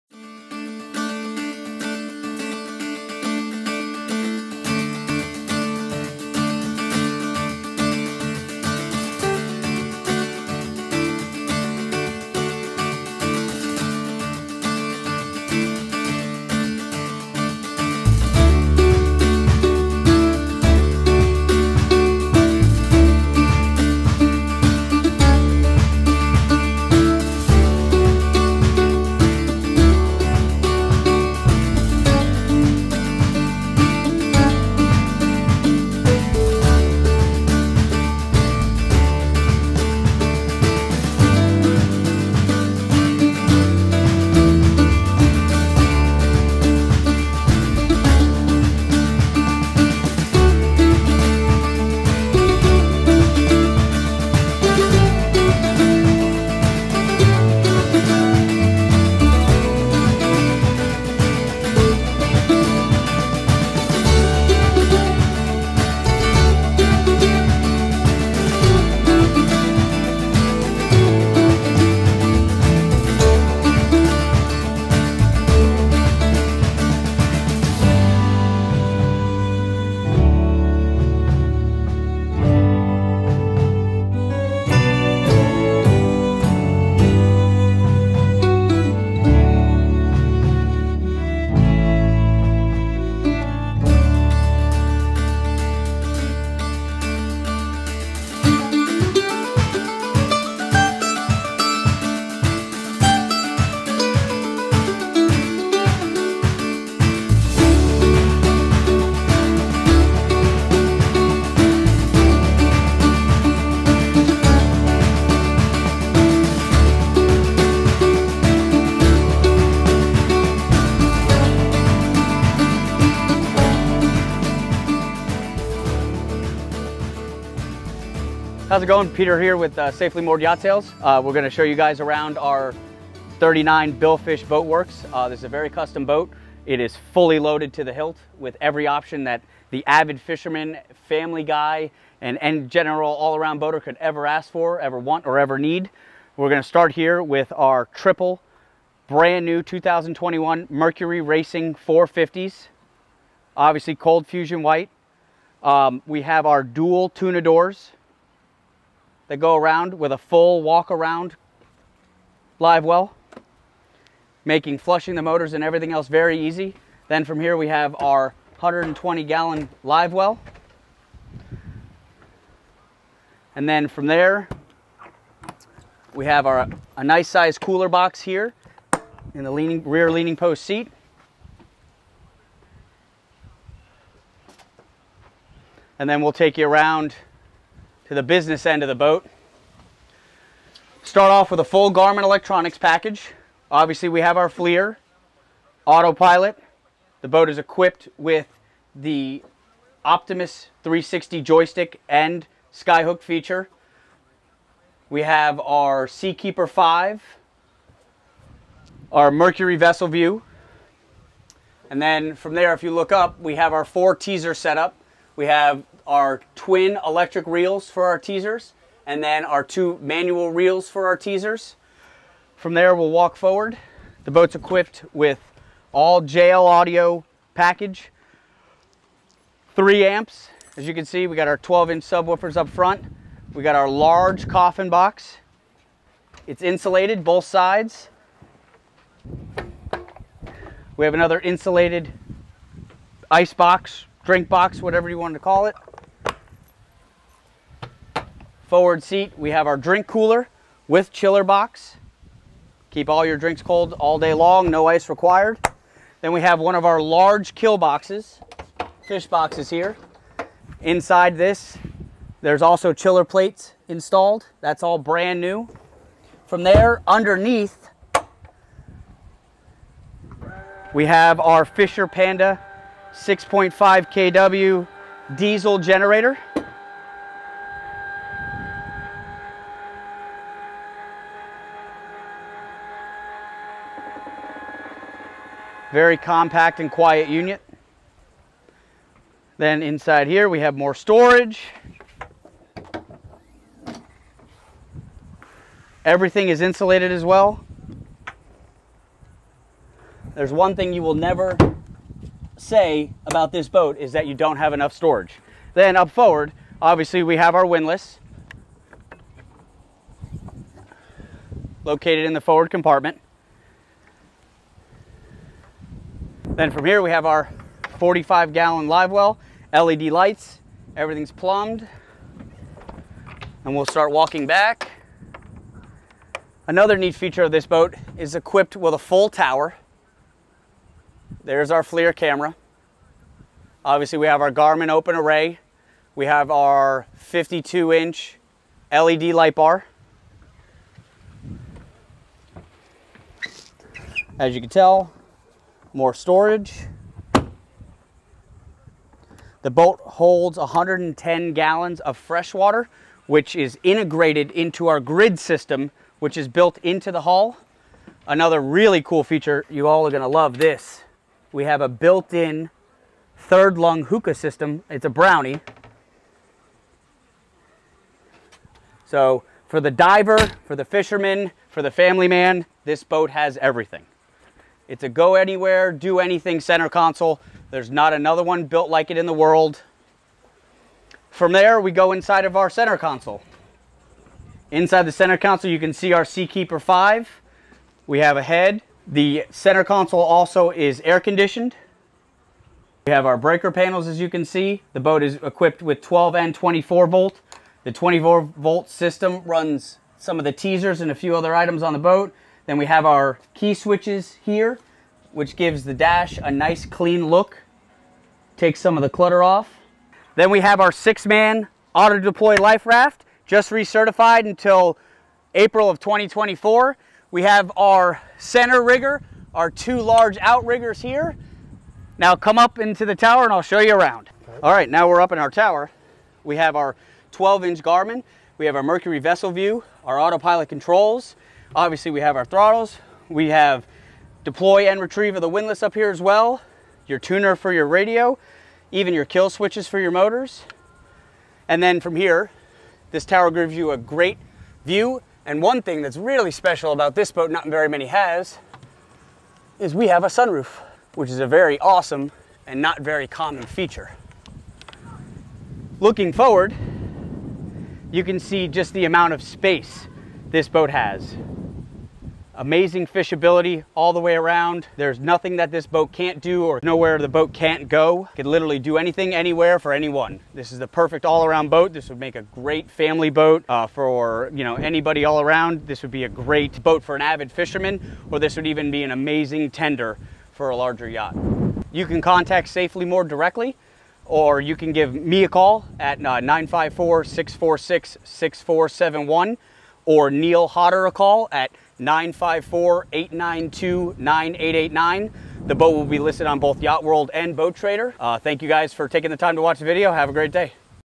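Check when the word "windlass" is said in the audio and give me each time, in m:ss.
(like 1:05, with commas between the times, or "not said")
5:07, 7:15.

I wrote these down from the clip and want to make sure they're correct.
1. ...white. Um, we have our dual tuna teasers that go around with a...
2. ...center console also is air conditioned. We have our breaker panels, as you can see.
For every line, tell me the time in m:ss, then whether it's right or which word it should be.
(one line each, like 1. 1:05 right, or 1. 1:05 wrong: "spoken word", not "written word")
1. 2:34 wrong: "doors", not "teasers"
2. 6:29 right.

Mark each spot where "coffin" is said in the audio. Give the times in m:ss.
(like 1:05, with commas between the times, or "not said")
3:54.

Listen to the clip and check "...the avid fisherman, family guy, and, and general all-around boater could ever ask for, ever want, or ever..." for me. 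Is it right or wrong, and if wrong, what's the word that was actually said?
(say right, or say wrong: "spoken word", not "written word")
right.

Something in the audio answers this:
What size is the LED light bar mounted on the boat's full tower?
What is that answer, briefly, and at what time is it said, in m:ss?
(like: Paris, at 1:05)
52 inch, at 5:37.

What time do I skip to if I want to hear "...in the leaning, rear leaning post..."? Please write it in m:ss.
2:59.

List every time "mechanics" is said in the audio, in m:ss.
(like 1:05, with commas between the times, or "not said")
not said.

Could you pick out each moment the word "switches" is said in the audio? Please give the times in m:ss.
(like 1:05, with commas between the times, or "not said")
6:43, 7:19.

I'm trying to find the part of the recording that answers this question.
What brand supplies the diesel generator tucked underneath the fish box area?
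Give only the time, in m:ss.
4:31.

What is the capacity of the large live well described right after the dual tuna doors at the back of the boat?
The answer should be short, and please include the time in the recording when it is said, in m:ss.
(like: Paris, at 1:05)
120 gallons, at 2:48.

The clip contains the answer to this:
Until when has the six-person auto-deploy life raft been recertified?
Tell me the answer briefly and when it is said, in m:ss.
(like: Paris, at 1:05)
April 2024, at 6:55.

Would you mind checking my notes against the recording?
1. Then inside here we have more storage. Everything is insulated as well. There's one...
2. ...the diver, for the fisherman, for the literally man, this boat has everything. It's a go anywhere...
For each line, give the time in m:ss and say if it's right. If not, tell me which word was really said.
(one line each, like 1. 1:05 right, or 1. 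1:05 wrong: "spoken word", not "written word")
1. 4:49 right
2. 6:09 wrong: "family", not "literally".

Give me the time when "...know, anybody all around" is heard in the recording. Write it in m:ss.
7:54.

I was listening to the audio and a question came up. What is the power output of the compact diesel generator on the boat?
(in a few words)
6.5 kW.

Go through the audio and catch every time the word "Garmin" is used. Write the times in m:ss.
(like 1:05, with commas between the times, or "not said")
3:11, 5:34, 7:07.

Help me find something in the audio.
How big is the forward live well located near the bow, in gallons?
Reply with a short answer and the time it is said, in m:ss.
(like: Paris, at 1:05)
45 gallons, at 5:17.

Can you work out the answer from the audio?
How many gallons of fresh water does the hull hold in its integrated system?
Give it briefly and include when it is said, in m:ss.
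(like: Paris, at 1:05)
110 gallons, at 5:50.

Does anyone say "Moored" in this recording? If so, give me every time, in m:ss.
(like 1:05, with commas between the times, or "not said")
2:10, 8:03.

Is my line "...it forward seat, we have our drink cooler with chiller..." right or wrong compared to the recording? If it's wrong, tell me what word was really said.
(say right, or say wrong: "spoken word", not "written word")
right.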